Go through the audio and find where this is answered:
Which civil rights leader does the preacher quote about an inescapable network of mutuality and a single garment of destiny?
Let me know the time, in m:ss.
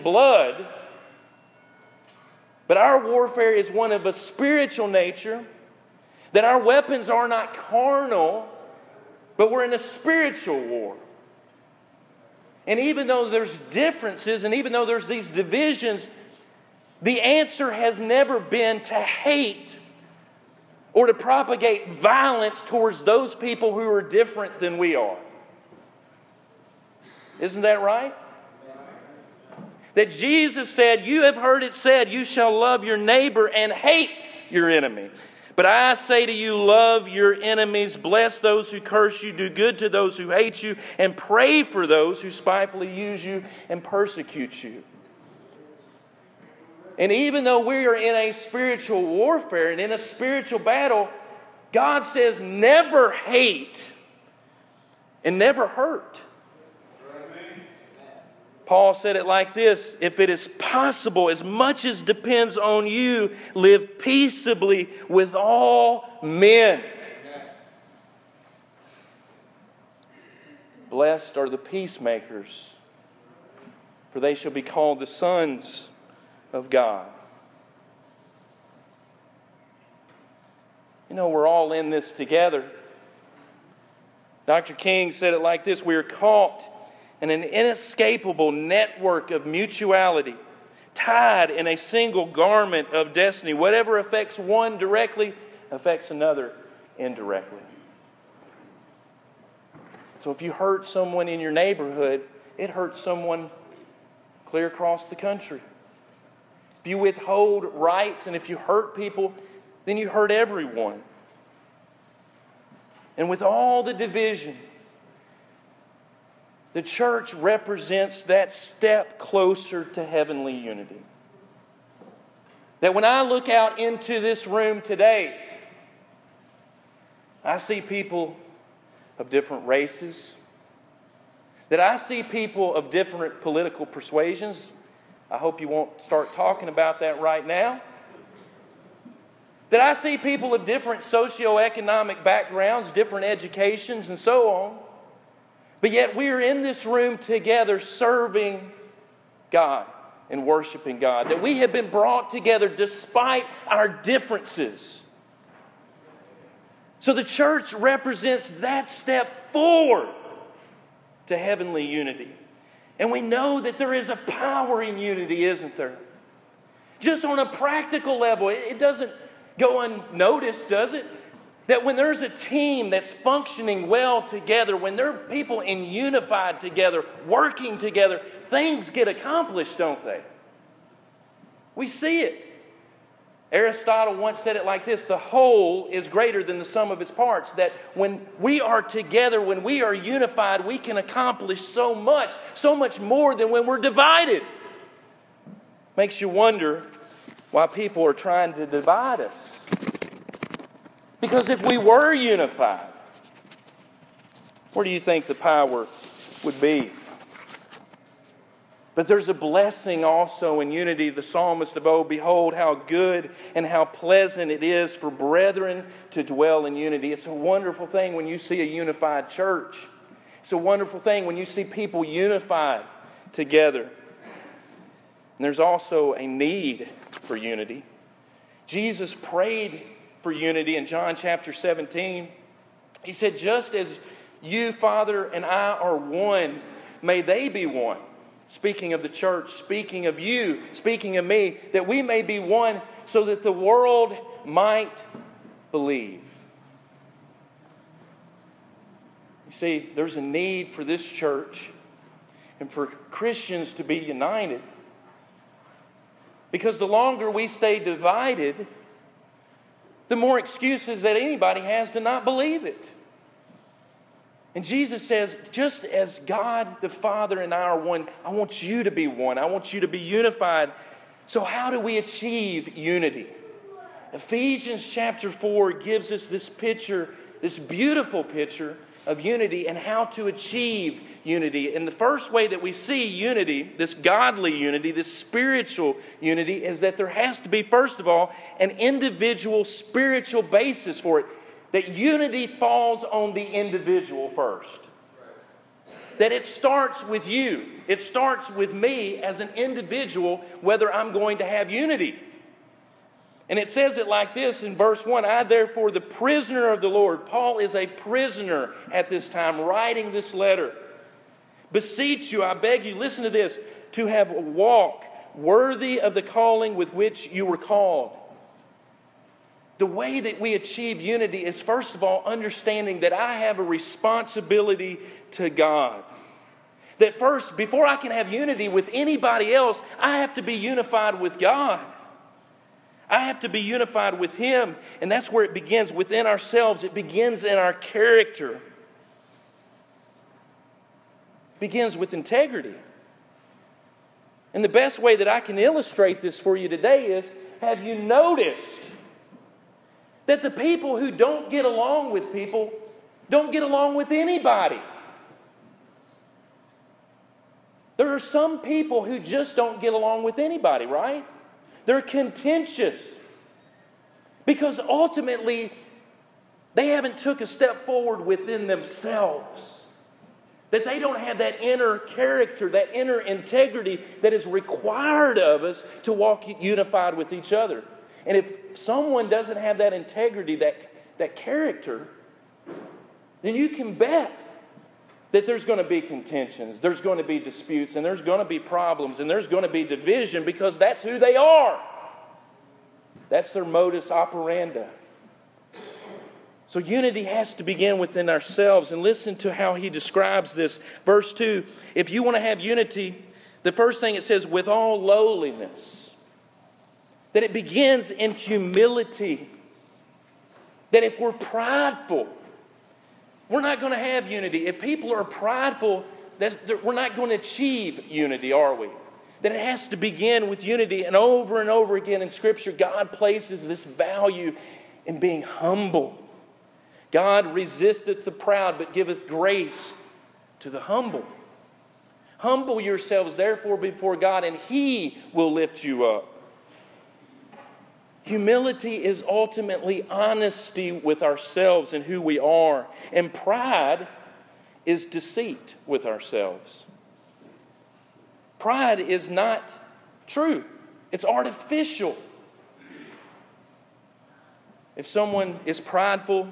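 1:24.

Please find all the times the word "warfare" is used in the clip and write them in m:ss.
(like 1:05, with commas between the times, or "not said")
0:03, 0:49.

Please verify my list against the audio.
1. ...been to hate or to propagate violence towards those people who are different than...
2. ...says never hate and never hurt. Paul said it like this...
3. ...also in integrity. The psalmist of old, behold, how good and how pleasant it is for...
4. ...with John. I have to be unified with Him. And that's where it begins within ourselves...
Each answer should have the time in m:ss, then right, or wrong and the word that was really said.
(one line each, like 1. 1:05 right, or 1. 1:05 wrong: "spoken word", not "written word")
1. 0:18 right
2. 0:52 right
3. 3:30 wrong: "unity", not "integrity"
4. 5:31 wrong: "God", not "John".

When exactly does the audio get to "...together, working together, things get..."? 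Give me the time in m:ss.
2:56.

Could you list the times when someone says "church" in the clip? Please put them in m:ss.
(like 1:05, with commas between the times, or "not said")
1:56, 2:37, 3:39, 3:59, 4:11.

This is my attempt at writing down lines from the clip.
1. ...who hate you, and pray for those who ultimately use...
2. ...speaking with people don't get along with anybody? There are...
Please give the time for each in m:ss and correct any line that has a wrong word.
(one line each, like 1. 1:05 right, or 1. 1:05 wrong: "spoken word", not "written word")
1. 0:40 wrong: "spitefully", not "ultimately"
2. 5:51 wrong: "along", not "speaking".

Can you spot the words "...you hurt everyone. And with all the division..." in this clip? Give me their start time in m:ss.
1:49.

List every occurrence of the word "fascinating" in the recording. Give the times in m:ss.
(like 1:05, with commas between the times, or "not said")
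not said.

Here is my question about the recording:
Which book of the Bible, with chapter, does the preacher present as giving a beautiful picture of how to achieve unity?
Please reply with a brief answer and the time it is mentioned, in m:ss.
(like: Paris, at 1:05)
Ephesians 4, at 4:34.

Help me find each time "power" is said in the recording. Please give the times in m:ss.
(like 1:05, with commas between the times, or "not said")
2:44, 3:25.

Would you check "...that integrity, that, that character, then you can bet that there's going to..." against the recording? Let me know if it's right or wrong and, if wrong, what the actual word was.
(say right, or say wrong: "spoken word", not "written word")
right.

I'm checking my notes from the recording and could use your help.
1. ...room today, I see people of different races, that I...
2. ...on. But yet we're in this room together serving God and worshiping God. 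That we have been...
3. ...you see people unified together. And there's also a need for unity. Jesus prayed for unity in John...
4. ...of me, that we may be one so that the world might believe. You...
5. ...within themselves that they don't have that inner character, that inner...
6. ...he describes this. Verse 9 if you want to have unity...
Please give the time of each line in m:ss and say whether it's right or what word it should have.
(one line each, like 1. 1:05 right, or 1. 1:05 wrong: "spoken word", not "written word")
1. 2:04 right
2. 2:24 right
3. 3:41 right
4. 4:01 right
5. 6:08 right
6. 6:39 wrong: "2", not "9".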